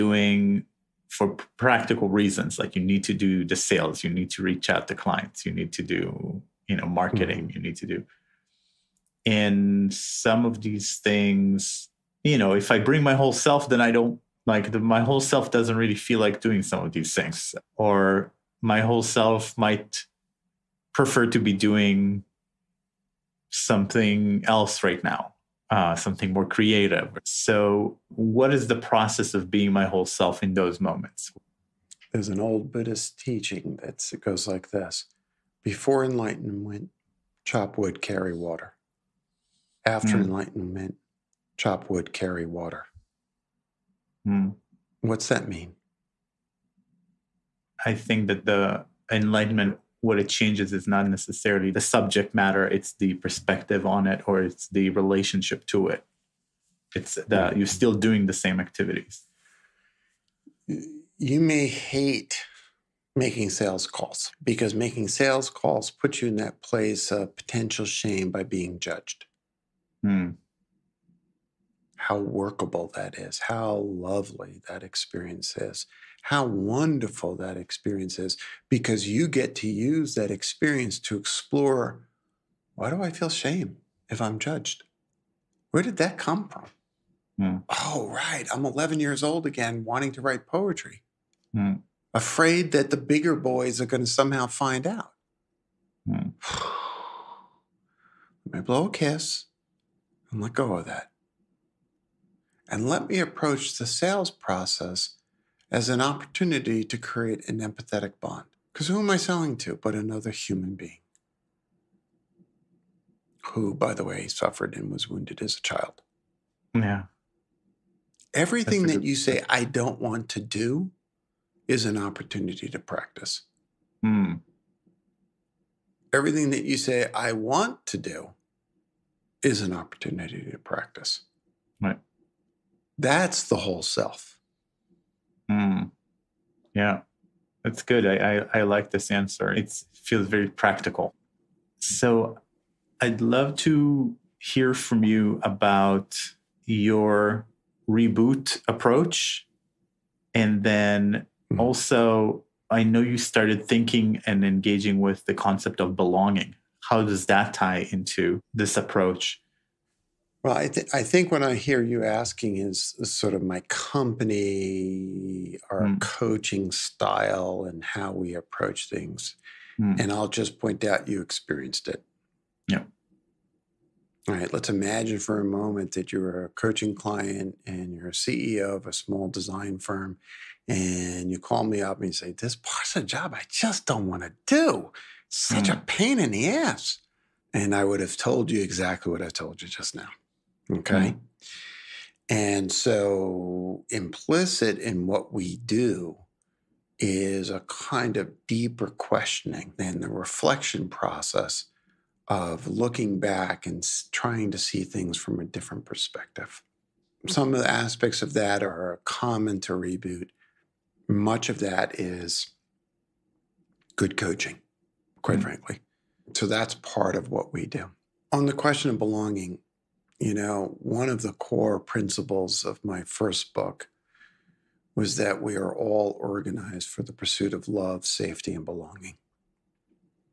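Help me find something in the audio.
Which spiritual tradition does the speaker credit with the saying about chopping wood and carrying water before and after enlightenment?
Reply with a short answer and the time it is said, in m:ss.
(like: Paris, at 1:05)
Buddhist, at 0:32.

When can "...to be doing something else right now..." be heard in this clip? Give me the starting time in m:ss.
0:21.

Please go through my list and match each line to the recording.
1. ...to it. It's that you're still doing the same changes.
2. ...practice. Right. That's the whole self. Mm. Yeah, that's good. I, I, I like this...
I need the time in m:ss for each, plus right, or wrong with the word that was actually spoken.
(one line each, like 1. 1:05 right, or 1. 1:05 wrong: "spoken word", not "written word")
1. 0:55 wrong: "activities", not "changes"
2. 2:10 right.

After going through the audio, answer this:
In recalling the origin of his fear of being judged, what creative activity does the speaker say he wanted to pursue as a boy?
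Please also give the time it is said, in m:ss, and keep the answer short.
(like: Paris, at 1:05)
Write poetry, at 1:30.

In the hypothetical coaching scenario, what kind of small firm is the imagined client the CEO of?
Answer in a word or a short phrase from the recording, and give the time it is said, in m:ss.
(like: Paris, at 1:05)
Design firm, at 2:59.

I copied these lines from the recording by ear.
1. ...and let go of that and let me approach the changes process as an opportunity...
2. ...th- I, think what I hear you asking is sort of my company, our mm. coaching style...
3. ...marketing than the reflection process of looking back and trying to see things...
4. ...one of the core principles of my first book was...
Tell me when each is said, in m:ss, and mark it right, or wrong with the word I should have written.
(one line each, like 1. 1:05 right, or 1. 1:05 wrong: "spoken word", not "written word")
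1. 1:40 wrong: "sales", not "changes"
2. 2:40 right
3. 3:18 wrong: "questioning", not "marketing"
4. 3:40 right.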